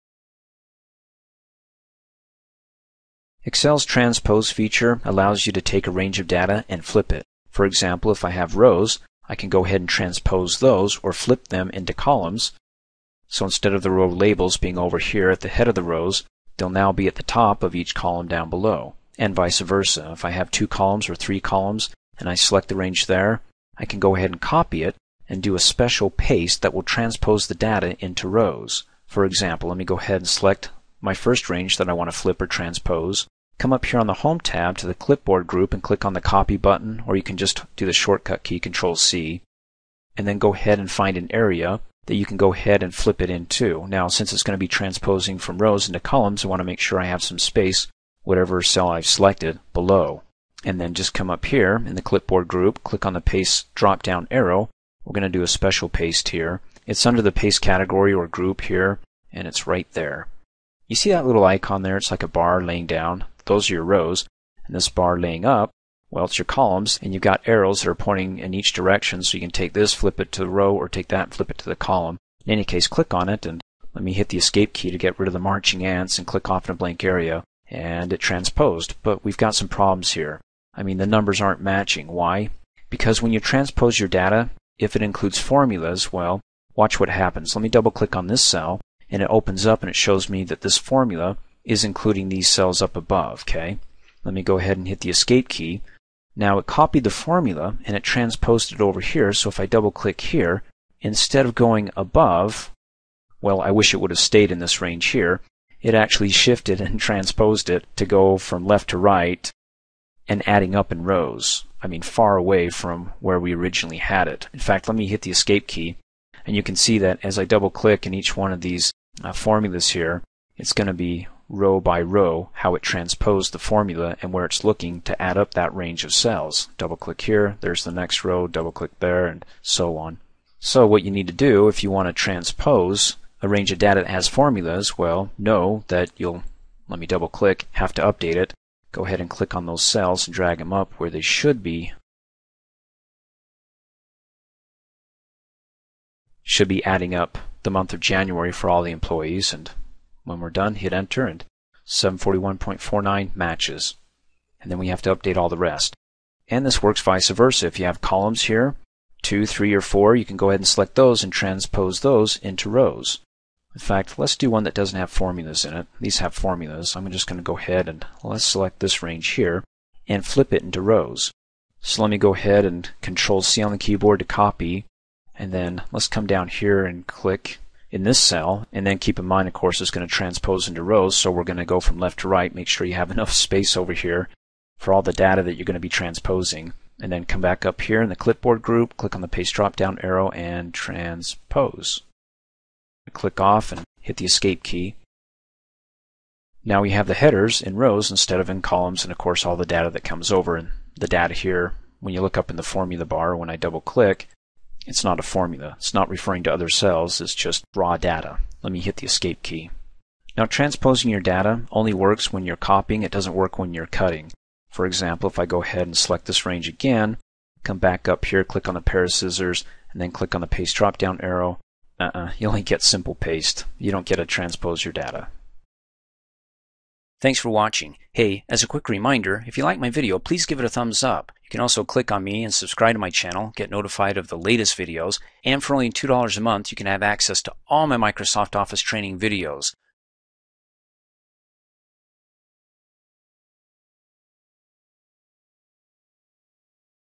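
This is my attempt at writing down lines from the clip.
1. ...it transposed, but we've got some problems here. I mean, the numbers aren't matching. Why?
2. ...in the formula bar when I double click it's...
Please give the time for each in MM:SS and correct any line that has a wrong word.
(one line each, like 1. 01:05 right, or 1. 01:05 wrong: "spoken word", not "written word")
1. 01:18 right
2. 03:22 right.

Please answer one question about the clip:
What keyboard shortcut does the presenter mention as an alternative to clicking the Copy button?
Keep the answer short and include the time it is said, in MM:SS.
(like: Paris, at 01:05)
Control-C, at 00:38.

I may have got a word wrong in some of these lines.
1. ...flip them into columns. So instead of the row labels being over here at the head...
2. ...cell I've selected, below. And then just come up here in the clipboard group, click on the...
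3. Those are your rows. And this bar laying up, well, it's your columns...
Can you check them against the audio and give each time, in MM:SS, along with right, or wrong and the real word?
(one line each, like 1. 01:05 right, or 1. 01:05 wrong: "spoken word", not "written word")
1. 00:11 right
2. 00:48 right
3. 01:03 right.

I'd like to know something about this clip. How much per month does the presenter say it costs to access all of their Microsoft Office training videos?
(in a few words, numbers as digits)
$2.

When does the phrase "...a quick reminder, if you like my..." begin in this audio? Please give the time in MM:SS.
03:48.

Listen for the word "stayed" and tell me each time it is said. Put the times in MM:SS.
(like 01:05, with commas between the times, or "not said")
01:44.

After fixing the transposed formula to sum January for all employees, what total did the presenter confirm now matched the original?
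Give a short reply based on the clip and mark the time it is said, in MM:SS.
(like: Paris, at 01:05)
741.49, at 02:31.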